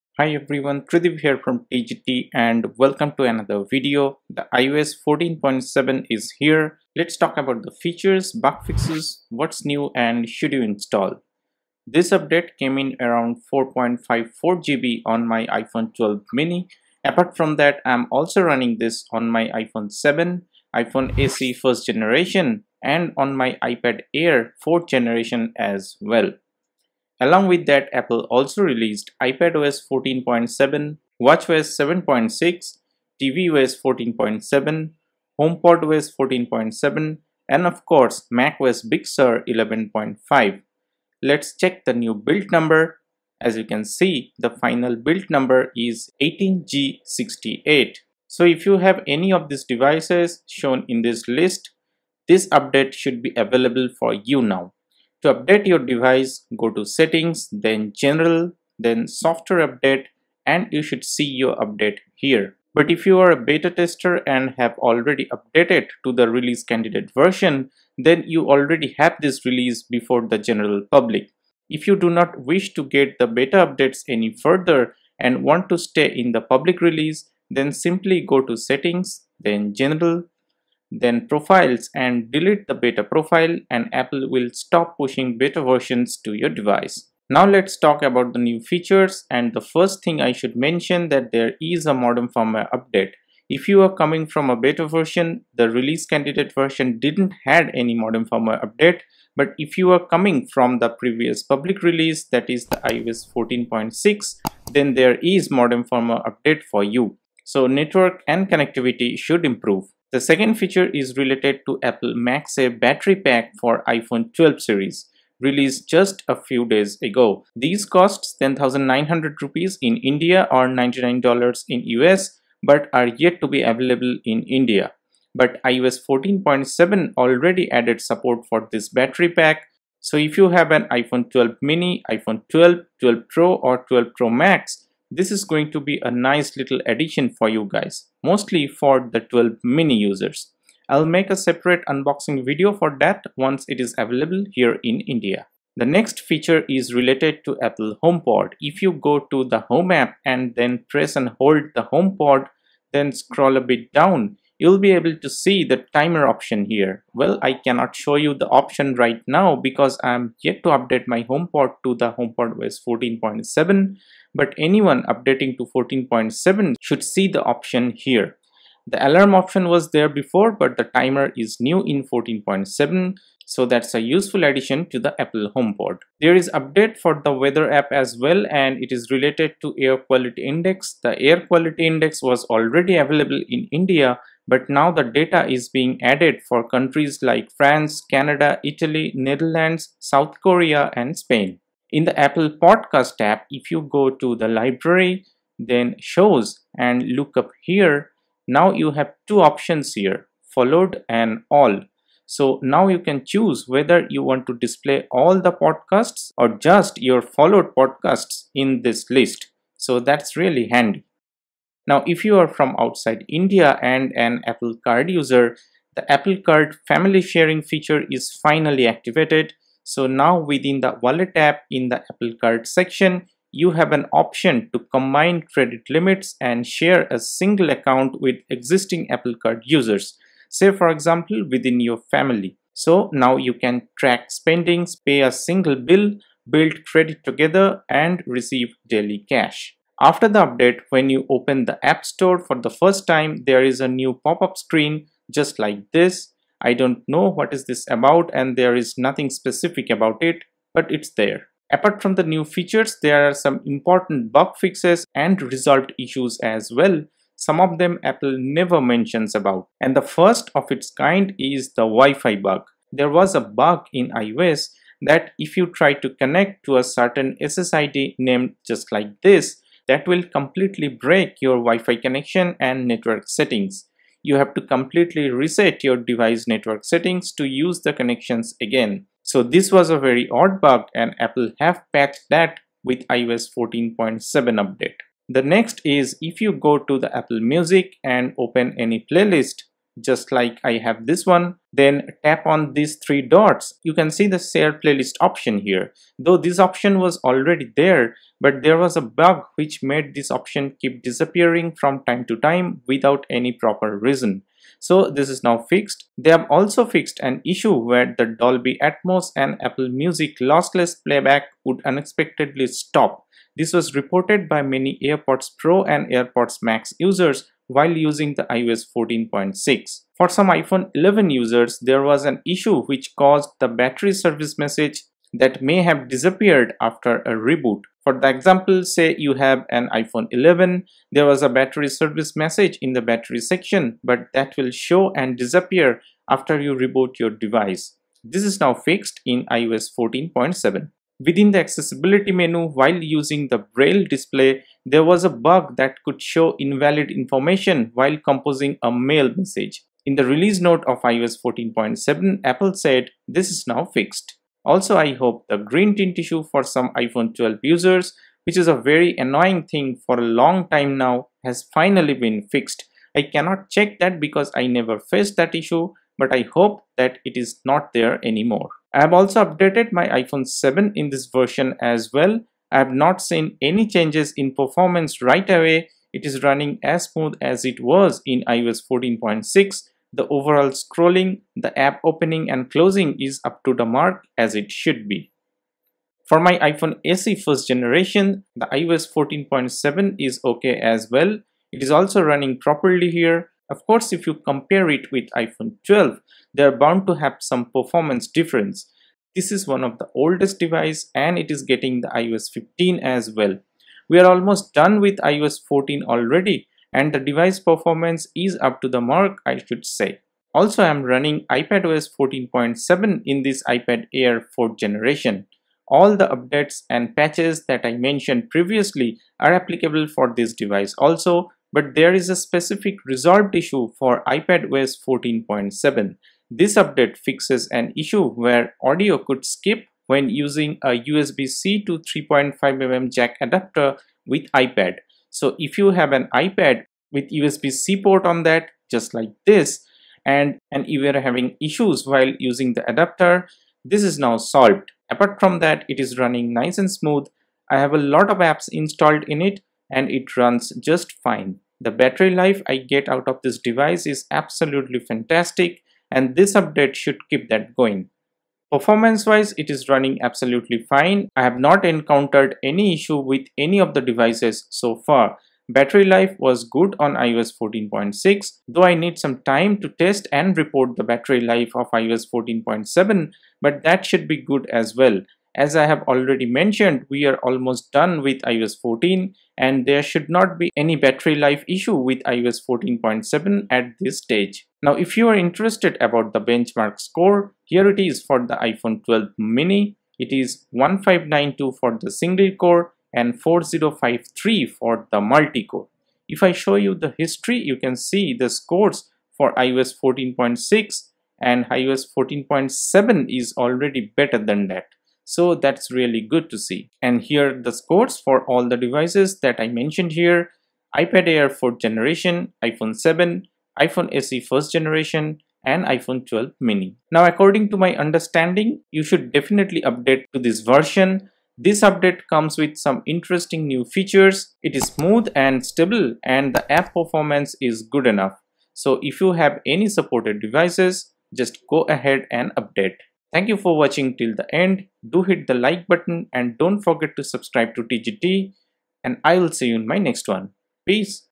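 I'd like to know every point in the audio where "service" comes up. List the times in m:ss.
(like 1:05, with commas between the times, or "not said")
5:24, 5:31.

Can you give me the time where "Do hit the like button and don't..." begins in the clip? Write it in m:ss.
8:55.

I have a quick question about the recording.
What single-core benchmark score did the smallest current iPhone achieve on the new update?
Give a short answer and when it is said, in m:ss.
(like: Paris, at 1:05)
1592, at 8:10.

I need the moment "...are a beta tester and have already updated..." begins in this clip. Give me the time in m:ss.
1:03.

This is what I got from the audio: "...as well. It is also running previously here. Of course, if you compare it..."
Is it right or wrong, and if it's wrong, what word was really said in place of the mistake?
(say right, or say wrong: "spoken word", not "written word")
wrong: "properly", not "previously".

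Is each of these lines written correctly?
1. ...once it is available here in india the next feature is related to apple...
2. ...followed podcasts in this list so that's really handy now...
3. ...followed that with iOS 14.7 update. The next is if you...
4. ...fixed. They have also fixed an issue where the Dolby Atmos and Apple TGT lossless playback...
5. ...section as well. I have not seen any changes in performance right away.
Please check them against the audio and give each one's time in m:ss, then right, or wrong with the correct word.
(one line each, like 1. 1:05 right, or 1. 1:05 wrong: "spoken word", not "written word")
1. 2:23 right
2. 3:27 right
3. 4:41 wrong: "patched", not "followed"
4. 5:05 wrong: "Music", not "TGT"
5. 6:11 wrong: "version", not "section".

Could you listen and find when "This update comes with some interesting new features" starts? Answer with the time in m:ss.
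8:41.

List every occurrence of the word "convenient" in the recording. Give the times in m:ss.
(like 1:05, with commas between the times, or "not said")
not said.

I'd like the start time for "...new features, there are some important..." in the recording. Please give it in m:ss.
4:12.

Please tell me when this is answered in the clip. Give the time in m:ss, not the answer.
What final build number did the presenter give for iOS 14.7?
0:46.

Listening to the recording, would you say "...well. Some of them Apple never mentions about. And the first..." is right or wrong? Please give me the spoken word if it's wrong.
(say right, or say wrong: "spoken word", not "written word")
right.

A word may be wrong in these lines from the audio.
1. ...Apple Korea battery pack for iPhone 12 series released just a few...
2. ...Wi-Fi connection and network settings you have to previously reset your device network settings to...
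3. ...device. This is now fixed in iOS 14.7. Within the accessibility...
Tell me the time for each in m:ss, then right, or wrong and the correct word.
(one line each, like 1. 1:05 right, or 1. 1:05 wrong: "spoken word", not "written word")
1. 1:51 wrong: "MagSafe", not "Korea"
2. 4:31 wrong: "completely", not "previously"
3. 5:37 right.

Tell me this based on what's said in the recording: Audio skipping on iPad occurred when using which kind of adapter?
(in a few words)
USB-C to 3.5mm jack.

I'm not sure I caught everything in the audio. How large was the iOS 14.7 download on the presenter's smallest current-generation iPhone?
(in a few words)
4.54 GB.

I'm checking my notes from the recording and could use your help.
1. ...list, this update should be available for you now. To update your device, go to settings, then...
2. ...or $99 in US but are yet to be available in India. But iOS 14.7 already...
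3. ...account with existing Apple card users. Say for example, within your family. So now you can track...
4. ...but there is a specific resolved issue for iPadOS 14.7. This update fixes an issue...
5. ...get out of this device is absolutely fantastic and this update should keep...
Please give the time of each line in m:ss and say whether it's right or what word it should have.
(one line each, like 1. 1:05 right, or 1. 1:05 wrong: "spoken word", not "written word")
1. 0:51 right
2. 2:00 right
3. 3:47 right
4. 7:01 right
5. 7:32 right.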